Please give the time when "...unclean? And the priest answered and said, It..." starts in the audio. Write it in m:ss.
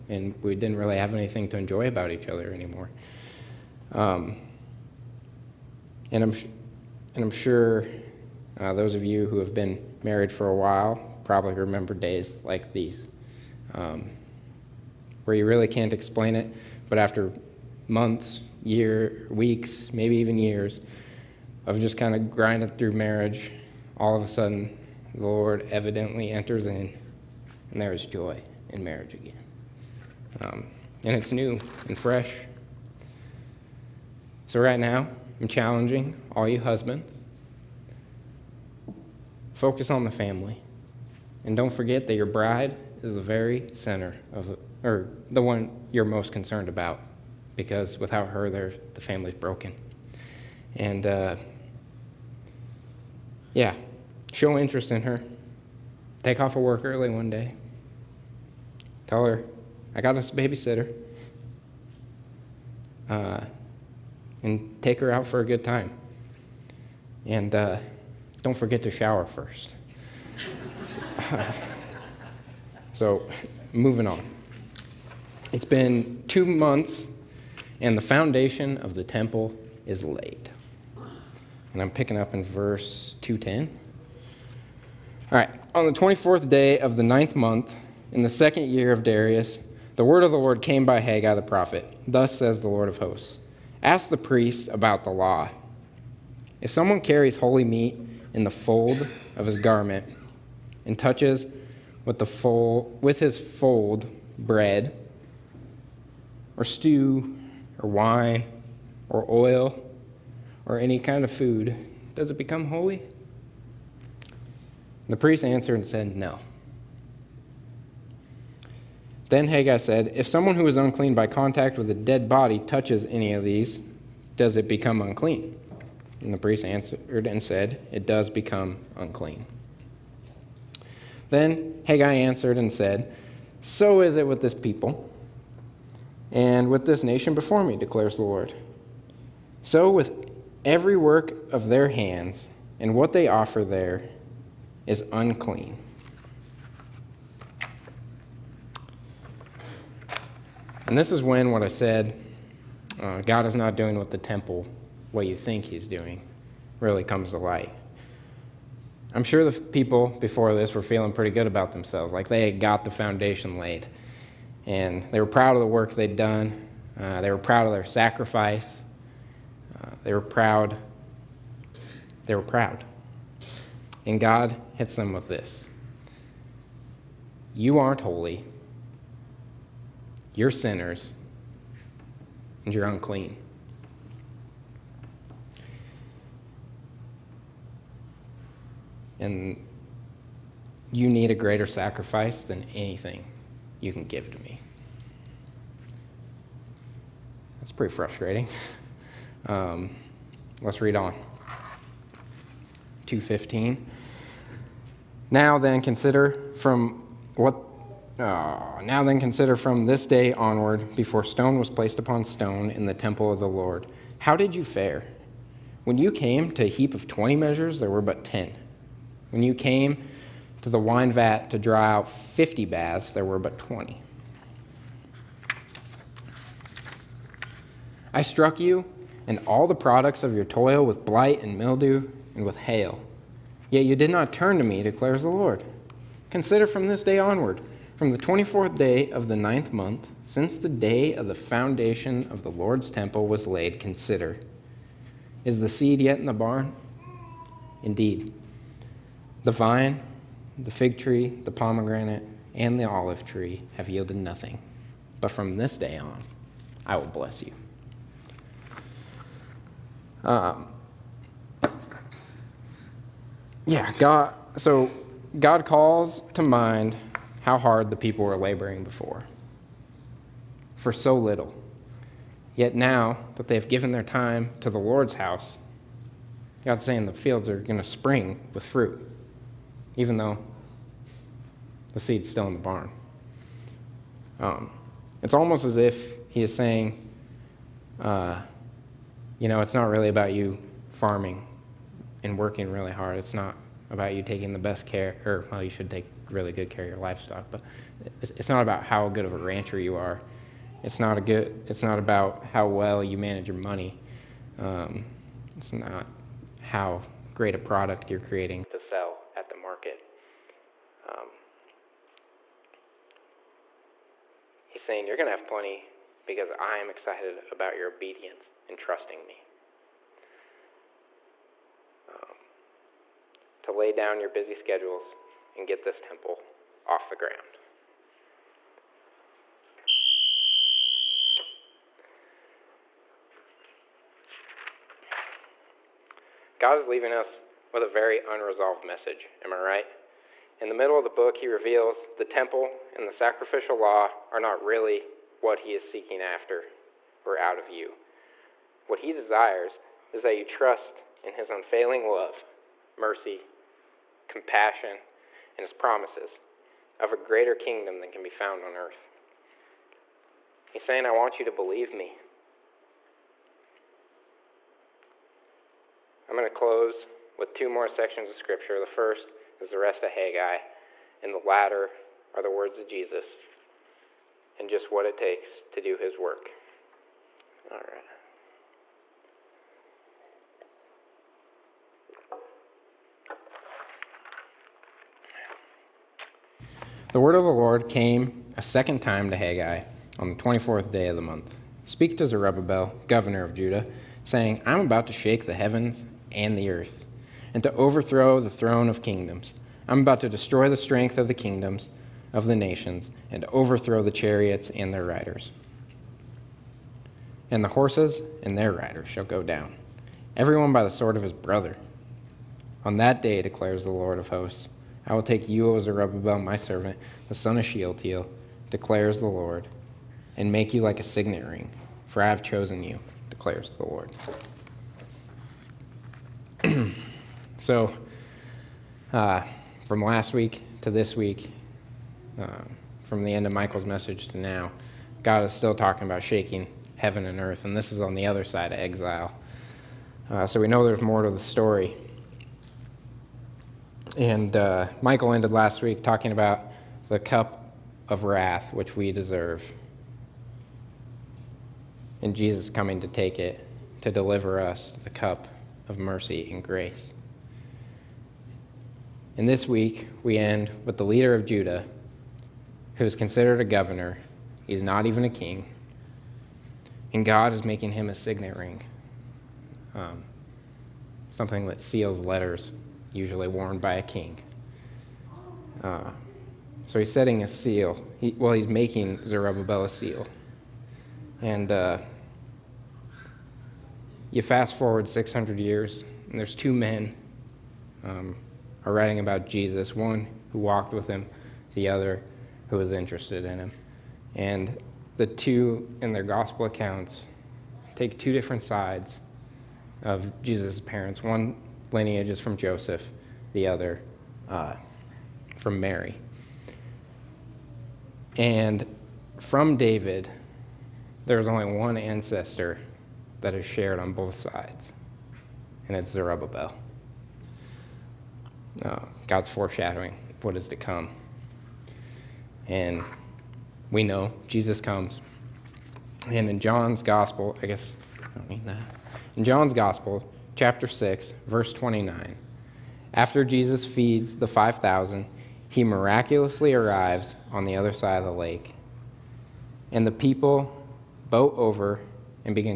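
2:05.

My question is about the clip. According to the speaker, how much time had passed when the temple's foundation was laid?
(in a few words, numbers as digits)
2 months.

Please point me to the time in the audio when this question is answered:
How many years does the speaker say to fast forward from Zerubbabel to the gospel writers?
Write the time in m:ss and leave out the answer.
8:05.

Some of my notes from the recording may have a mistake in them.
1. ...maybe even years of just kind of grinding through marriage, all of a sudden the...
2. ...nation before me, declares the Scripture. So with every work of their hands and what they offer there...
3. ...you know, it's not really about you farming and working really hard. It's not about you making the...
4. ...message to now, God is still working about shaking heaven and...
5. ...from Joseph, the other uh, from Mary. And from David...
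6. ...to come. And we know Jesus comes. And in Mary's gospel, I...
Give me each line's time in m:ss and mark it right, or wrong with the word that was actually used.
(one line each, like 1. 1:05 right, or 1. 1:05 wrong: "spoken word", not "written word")
1. 0:19 right
2. 2:17 wrong: "Lord", not "Scripture"
3. 4:49 wrong: "taking", not "making"
4. 7:13 wrong: "talking", not "working"
5. 8:22 right
6. 8:40 wrong: "John", not "Mary".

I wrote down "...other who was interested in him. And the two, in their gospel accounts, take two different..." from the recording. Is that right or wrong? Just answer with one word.
right.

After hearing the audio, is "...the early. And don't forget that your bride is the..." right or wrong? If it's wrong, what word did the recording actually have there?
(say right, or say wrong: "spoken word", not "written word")
wrong: "family", not "early".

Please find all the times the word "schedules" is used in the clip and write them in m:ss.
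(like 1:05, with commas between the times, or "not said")
5:24.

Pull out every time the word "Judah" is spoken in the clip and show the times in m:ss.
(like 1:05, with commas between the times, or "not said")
6:33, 7:41.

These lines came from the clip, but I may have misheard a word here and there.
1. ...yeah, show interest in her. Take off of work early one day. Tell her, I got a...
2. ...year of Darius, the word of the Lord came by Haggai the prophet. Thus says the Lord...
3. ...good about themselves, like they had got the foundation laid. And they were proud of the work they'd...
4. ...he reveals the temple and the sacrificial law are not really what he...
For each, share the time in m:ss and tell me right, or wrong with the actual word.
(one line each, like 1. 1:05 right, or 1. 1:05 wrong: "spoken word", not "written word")
1. 0:53 right
2. 1:28 right
3. 2:41 right
4. 5:41 right.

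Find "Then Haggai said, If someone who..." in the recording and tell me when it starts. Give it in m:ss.
1:59.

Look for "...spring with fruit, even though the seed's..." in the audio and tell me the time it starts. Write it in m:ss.
4:37.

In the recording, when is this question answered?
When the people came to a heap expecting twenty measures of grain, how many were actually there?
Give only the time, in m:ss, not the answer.
3:38.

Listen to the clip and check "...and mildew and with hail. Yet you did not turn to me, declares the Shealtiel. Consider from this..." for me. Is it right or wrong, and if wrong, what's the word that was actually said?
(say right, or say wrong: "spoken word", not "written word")
wrong: "Lord", not "Shealtiel".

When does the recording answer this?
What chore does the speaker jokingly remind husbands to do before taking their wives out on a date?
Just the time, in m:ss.
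1:08.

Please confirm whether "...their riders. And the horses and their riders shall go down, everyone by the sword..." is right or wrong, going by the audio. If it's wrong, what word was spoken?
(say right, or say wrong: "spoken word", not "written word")
right.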